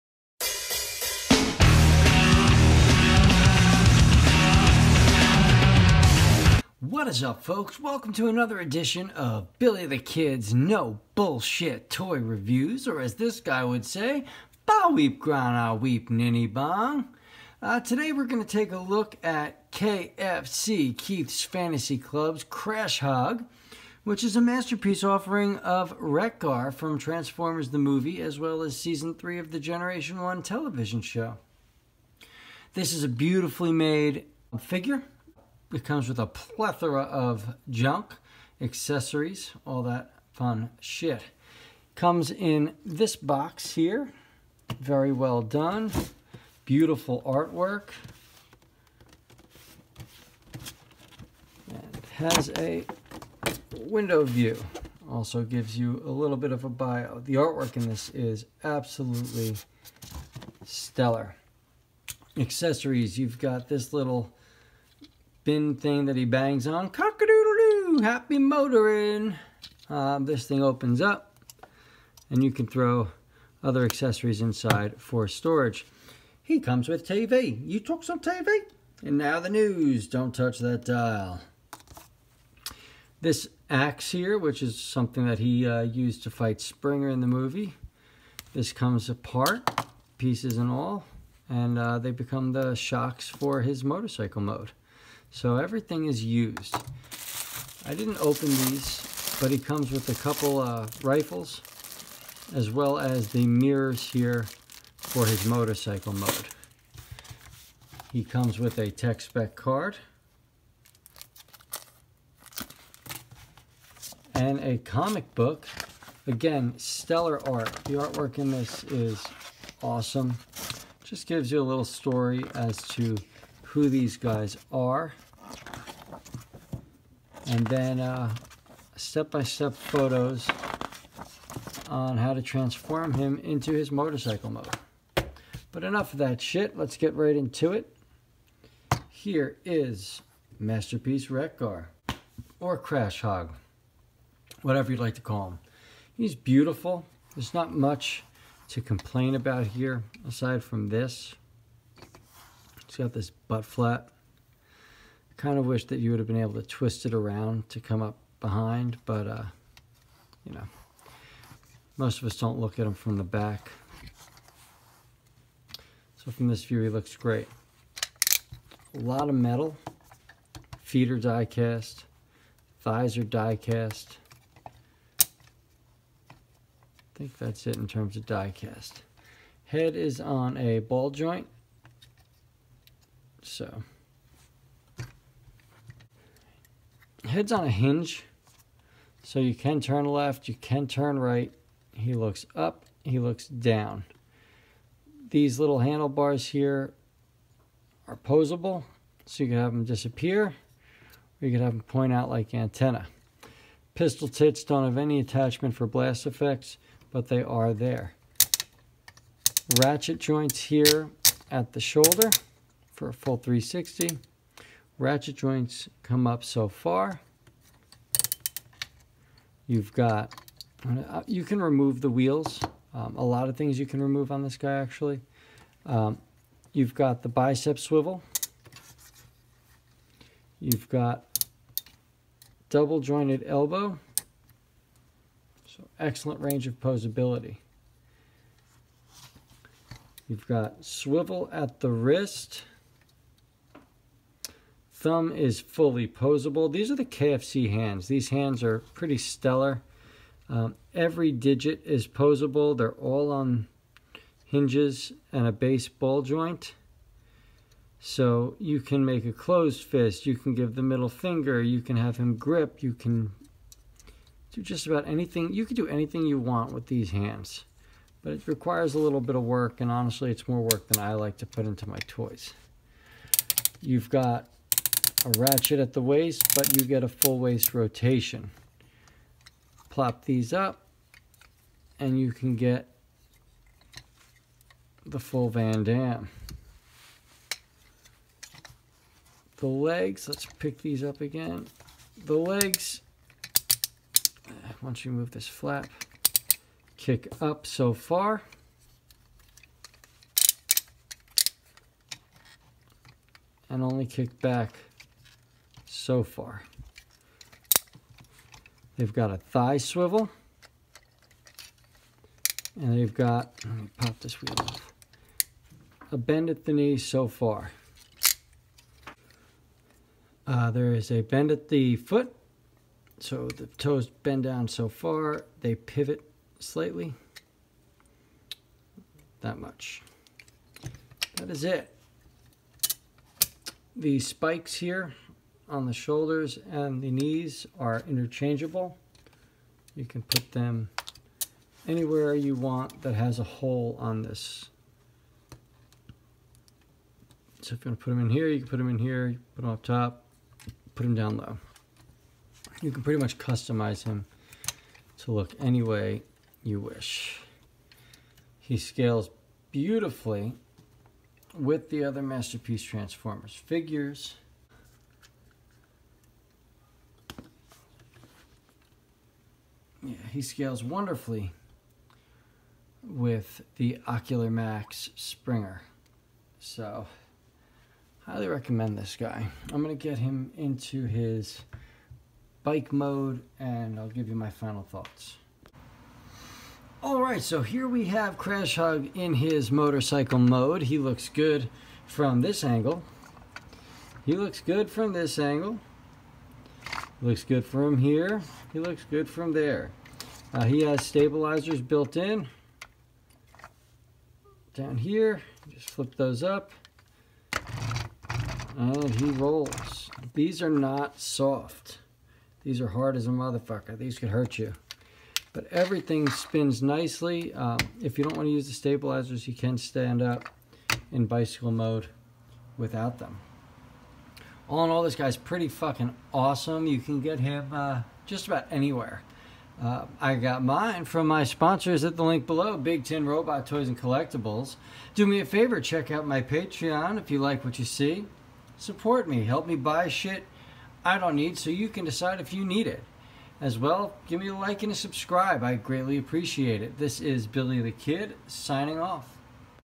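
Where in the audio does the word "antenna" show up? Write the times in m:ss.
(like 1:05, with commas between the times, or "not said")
3:22.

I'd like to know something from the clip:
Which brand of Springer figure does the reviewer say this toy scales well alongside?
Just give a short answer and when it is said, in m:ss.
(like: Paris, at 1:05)
Ocular Max, at 6:14.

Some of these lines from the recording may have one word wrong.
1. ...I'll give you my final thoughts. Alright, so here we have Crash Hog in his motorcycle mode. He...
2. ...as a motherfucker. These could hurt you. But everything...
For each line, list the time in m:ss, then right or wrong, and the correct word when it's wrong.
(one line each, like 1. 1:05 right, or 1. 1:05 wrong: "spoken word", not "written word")
1. 6:23 right
2. 6:53 right.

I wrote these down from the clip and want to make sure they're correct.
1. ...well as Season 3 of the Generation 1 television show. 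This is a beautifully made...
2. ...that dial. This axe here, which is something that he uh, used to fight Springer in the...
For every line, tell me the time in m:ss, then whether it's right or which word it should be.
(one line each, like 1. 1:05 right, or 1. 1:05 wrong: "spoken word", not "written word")
1. 0:28 right
2. 1:20 right.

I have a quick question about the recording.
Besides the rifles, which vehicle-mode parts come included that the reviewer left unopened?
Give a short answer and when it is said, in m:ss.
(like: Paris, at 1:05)
mirrors, at 1:43.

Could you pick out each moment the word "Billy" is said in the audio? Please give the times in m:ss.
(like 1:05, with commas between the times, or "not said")
0:09, 7:27.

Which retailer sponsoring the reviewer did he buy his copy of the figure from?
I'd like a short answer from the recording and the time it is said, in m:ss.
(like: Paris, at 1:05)
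Big Tin Robot Toys and Collectibles, at 7:12.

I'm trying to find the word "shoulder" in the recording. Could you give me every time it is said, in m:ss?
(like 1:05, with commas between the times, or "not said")
3:31, 5:35.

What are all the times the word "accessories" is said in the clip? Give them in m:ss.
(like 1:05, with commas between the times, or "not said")
0:38, 1:02, 1:13.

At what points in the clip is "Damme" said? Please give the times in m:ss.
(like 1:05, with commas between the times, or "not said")
4:45.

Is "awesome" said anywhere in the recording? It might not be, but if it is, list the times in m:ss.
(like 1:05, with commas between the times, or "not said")
1:59, 7:06.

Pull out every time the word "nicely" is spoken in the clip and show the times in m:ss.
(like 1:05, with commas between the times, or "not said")
6:56.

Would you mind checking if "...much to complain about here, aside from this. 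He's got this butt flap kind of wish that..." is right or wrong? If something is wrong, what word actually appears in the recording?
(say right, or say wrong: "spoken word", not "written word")
right.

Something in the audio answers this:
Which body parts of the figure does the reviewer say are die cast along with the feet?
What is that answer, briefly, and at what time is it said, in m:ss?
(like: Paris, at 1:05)
Thighs, at 2:52.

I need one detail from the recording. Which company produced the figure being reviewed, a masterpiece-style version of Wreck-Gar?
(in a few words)
Keith's Fantasy Club.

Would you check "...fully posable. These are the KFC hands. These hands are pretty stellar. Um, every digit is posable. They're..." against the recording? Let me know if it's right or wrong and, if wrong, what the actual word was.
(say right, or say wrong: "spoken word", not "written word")
right.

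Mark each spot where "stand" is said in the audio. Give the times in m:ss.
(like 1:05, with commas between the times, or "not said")
6:59.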